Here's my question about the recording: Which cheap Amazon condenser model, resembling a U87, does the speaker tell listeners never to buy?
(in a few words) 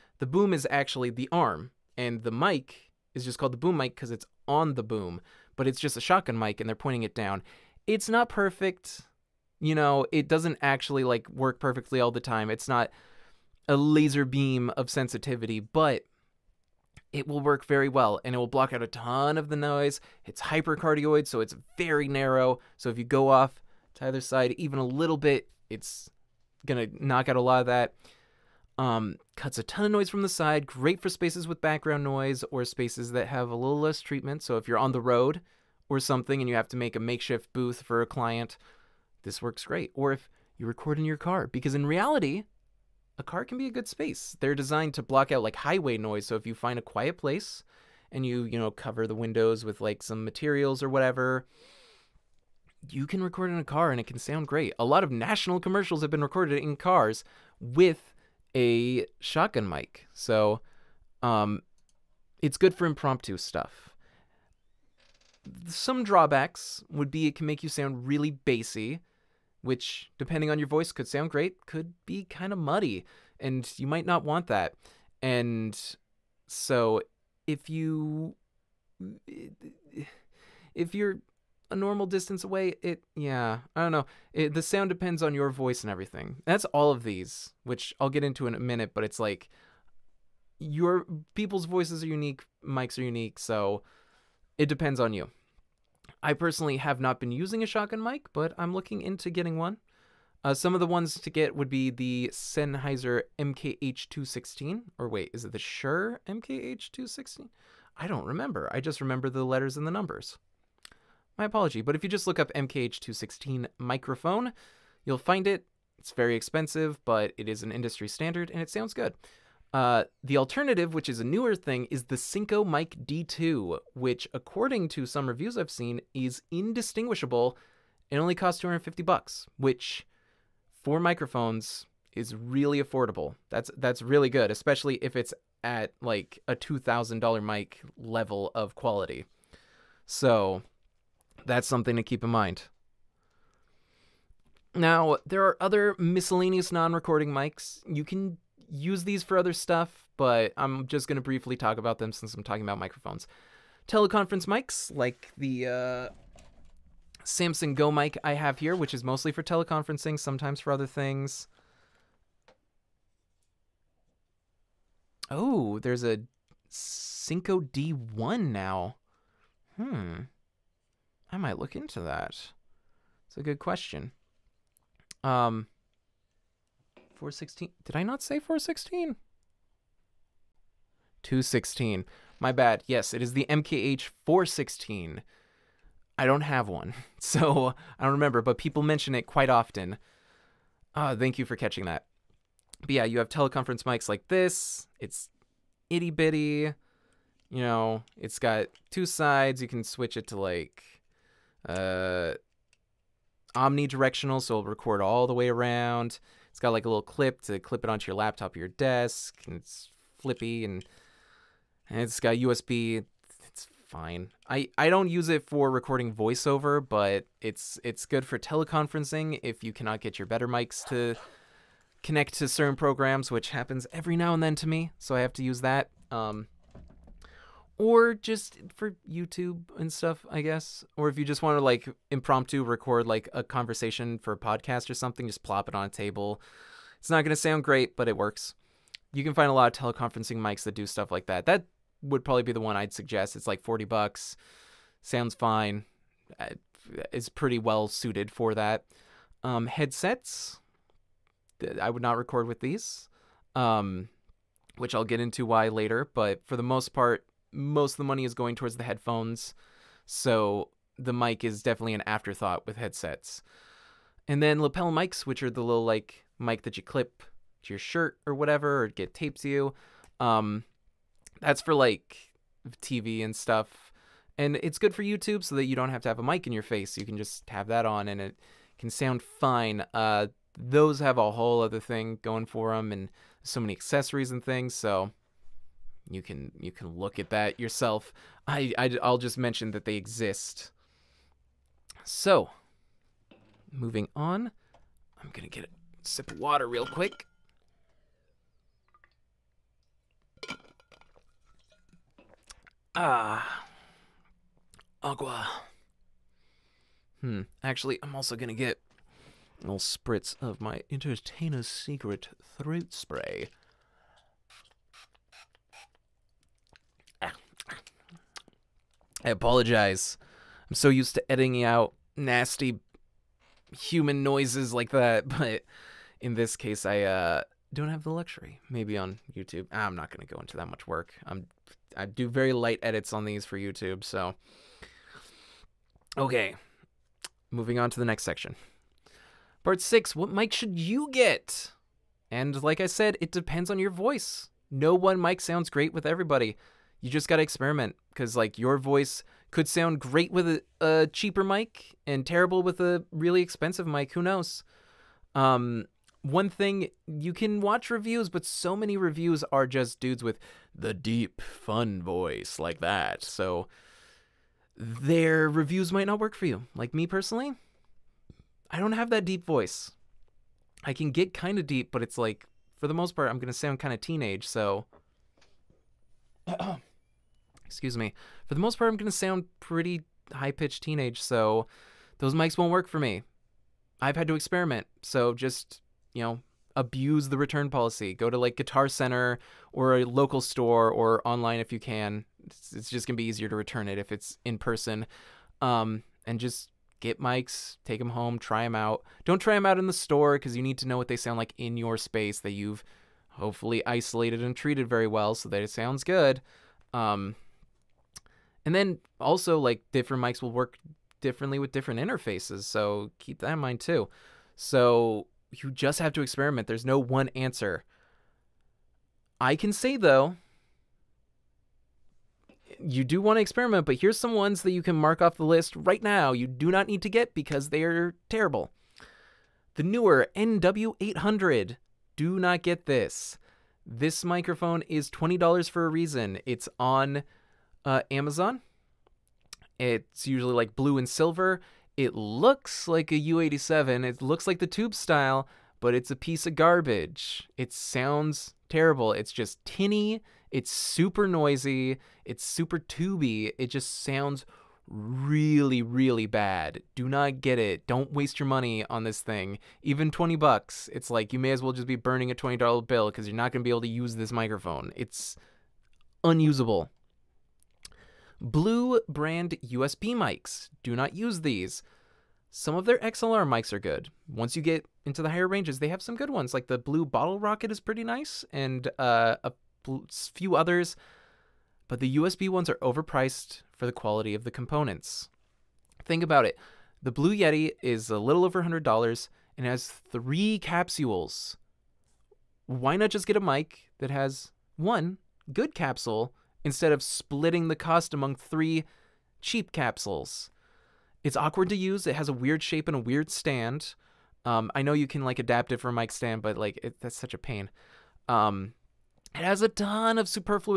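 Neewer NW800.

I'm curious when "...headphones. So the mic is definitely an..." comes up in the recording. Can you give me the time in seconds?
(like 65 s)
258 s.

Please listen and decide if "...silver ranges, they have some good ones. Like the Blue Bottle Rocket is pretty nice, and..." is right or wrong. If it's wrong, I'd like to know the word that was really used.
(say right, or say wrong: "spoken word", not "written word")
wrong: "higher", not "silver".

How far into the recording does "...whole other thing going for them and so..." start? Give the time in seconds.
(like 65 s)
281 s.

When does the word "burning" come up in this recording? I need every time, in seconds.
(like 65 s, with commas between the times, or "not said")
461 s.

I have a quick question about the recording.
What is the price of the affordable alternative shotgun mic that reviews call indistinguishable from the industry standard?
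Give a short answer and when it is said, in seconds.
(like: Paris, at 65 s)
$250, at 128 s.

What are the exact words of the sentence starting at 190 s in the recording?
Uh, thank you for catching that.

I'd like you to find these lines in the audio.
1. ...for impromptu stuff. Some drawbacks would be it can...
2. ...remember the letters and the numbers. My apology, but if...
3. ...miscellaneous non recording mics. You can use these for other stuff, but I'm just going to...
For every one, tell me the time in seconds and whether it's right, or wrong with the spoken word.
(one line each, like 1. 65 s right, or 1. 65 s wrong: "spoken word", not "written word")
1. 62 s right
2. 108 s right
3. 145 s right.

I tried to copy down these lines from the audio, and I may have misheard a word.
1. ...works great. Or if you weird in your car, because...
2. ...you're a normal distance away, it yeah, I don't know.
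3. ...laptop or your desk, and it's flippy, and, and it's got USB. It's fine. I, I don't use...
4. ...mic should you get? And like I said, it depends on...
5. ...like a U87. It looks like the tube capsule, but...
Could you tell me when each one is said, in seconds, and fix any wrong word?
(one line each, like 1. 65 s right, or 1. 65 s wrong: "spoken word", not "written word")
1. 39 s wrong: "record", not "weird"
2. 80 s right
3. 208 s right
4. 340 s right
5. 442 s wrong: "style", not "capsule".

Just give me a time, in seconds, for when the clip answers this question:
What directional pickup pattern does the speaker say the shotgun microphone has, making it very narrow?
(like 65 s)
20 s.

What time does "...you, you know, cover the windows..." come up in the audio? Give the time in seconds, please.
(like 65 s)
48 s.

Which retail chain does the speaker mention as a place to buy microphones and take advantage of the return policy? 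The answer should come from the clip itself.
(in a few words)
Guitar Center.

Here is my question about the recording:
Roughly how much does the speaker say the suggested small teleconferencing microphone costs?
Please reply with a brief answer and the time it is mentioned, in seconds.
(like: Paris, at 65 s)
$40, at 243 s.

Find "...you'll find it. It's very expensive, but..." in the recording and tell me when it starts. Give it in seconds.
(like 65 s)
115 s.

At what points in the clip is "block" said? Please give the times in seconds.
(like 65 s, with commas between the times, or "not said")
18 s, 45 s.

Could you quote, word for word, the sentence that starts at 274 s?
And it's good for YouTube so that you don't have to have a mic in your face.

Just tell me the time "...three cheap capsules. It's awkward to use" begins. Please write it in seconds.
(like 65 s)
498 s.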